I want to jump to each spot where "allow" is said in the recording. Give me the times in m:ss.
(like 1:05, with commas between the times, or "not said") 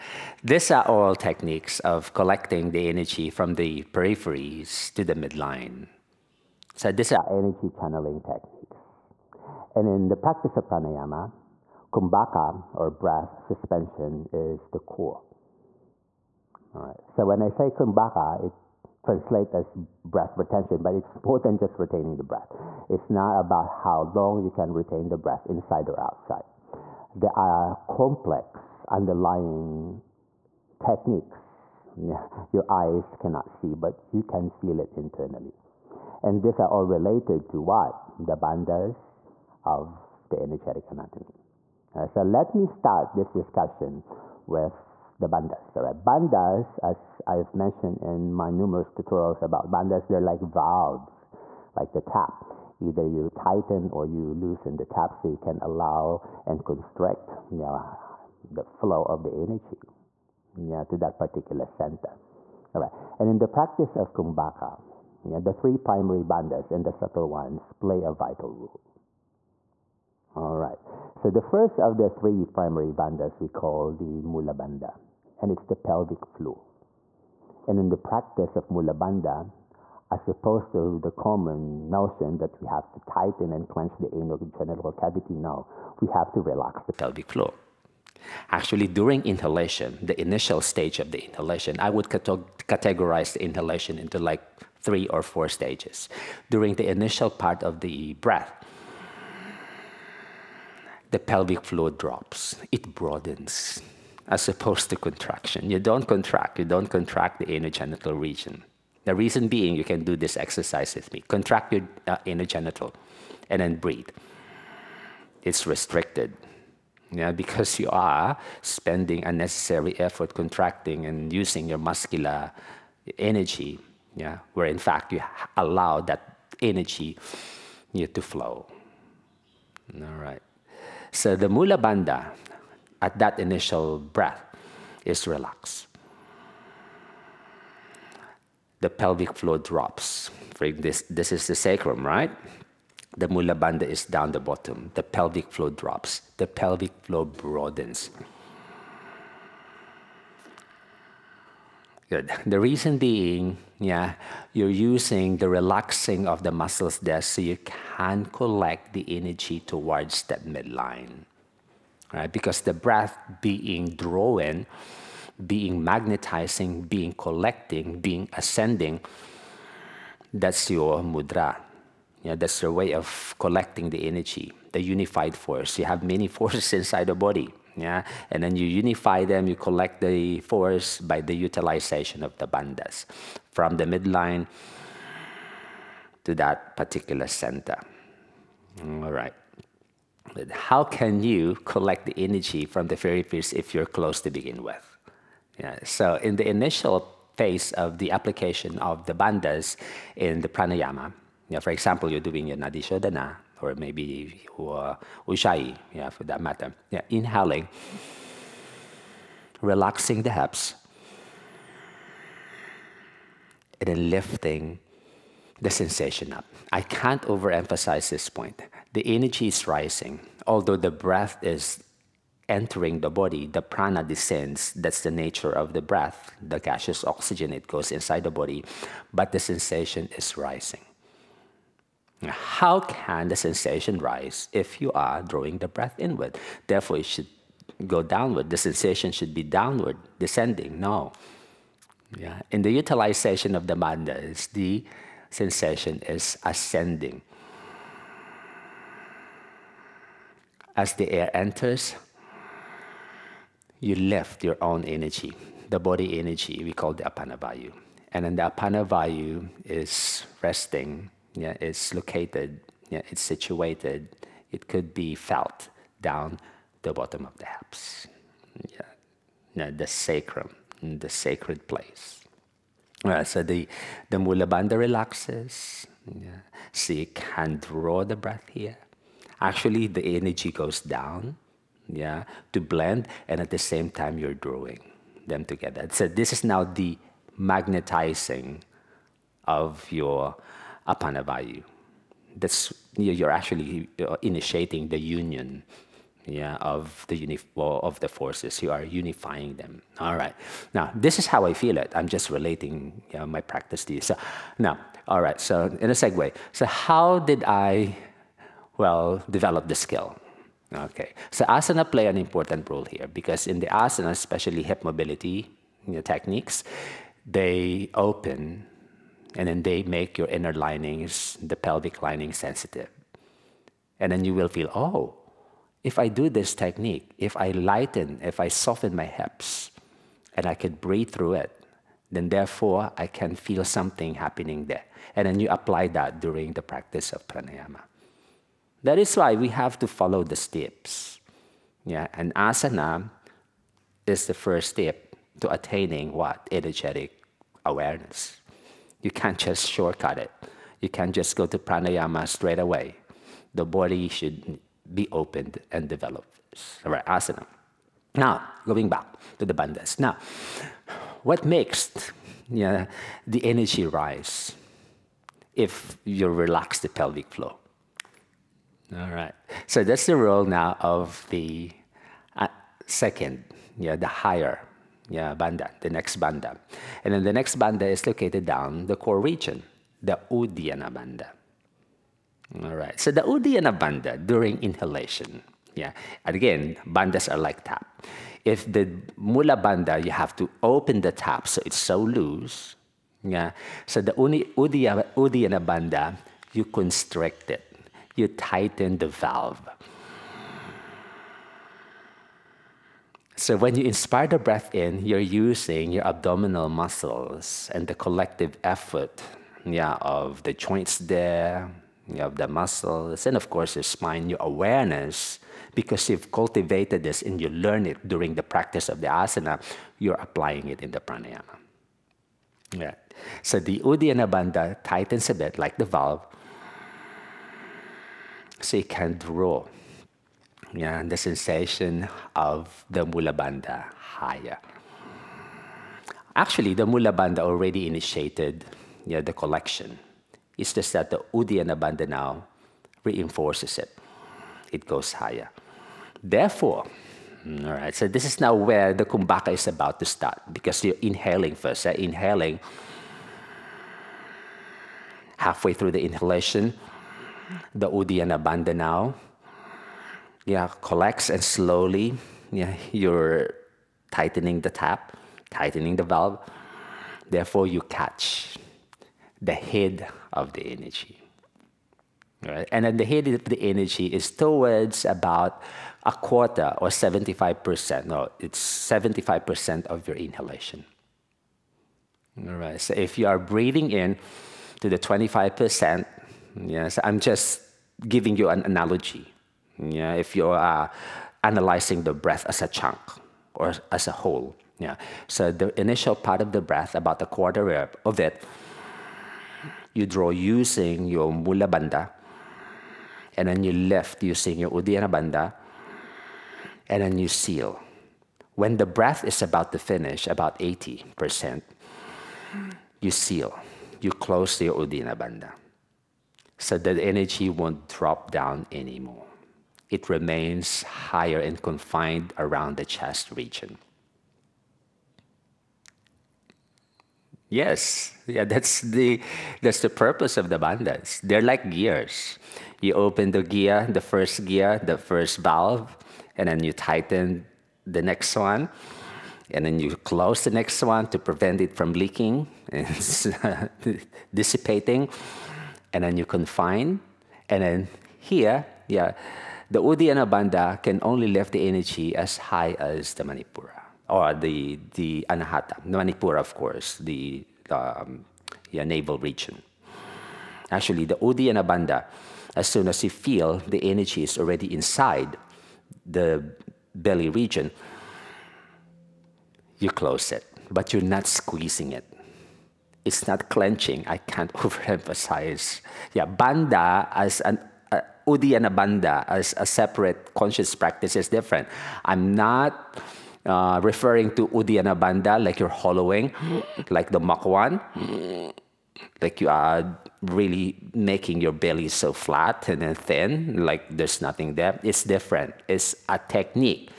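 0:55, 2:05.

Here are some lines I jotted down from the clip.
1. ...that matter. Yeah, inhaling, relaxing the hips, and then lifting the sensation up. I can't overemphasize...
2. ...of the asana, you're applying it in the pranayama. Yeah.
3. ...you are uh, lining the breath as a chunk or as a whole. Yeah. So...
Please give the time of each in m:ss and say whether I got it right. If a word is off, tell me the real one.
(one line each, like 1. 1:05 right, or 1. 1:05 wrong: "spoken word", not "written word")
1. 3:26 right
2. 6:58 right
3. 8:10 wrong: "analyzing", not "lining".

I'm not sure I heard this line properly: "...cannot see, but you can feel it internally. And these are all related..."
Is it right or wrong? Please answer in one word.
right.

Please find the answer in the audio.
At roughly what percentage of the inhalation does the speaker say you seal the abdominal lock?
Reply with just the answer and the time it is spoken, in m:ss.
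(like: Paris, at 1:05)
80%, at 8:30.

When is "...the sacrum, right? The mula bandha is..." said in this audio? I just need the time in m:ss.
2:21.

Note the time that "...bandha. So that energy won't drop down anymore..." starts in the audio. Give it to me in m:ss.
8:35.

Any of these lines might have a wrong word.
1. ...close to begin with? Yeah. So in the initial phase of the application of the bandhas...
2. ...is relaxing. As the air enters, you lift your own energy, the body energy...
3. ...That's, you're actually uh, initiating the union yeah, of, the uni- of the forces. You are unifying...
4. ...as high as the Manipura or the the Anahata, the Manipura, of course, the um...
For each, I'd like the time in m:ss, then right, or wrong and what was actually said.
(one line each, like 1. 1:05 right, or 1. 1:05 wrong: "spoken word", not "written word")
1. 3:13 right
2. 4:06 wrong: "ascending", not "relaxing"
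3. 4:52 right
4. 9:12 right.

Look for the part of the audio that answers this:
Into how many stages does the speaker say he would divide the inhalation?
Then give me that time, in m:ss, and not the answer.
1:34.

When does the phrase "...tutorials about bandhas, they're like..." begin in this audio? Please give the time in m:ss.
0:48.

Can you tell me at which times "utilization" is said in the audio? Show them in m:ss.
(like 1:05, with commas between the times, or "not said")
3:01, 4:02.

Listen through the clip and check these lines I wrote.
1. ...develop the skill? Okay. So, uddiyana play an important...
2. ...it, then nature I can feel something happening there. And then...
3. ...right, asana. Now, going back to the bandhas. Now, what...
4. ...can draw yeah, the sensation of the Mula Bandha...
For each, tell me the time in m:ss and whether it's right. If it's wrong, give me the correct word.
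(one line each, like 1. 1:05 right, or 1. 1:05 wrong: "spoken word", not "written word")
1. 5:09 wrong: "asana", not "uddiyana"
2. 5:31 wrong: "therefore", not "nature"
3. 5:56 right
4. 7:08 right.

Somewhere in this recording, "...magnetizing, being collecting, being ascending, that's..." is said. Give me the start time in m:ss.
2:45.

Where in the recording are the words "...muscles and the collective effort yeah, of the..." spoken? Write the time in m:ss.
6:46.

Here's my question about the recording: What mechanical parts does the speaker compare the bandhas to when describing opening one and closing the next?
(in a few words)
gears.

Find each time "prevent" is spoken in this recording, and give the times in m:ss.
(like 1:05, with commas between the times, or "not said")
9:01.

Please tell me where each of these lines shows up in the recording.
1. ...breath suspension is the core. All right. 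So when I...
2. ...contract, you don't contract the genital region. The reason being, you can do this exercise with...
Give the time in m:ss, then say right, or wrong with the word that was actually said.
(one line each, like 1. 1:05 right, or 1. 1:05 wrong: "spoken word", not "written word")
1. 0:12 right
2. 1:46 right.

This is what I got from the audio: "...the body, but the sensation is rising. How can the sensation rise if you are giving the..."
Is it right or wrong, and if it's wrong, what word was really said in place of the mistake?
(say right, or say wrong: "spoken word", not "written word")
wrong: "drawing", not "giving".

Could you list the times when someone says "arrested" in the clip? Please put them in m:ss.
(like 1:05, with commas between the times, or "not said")
not said.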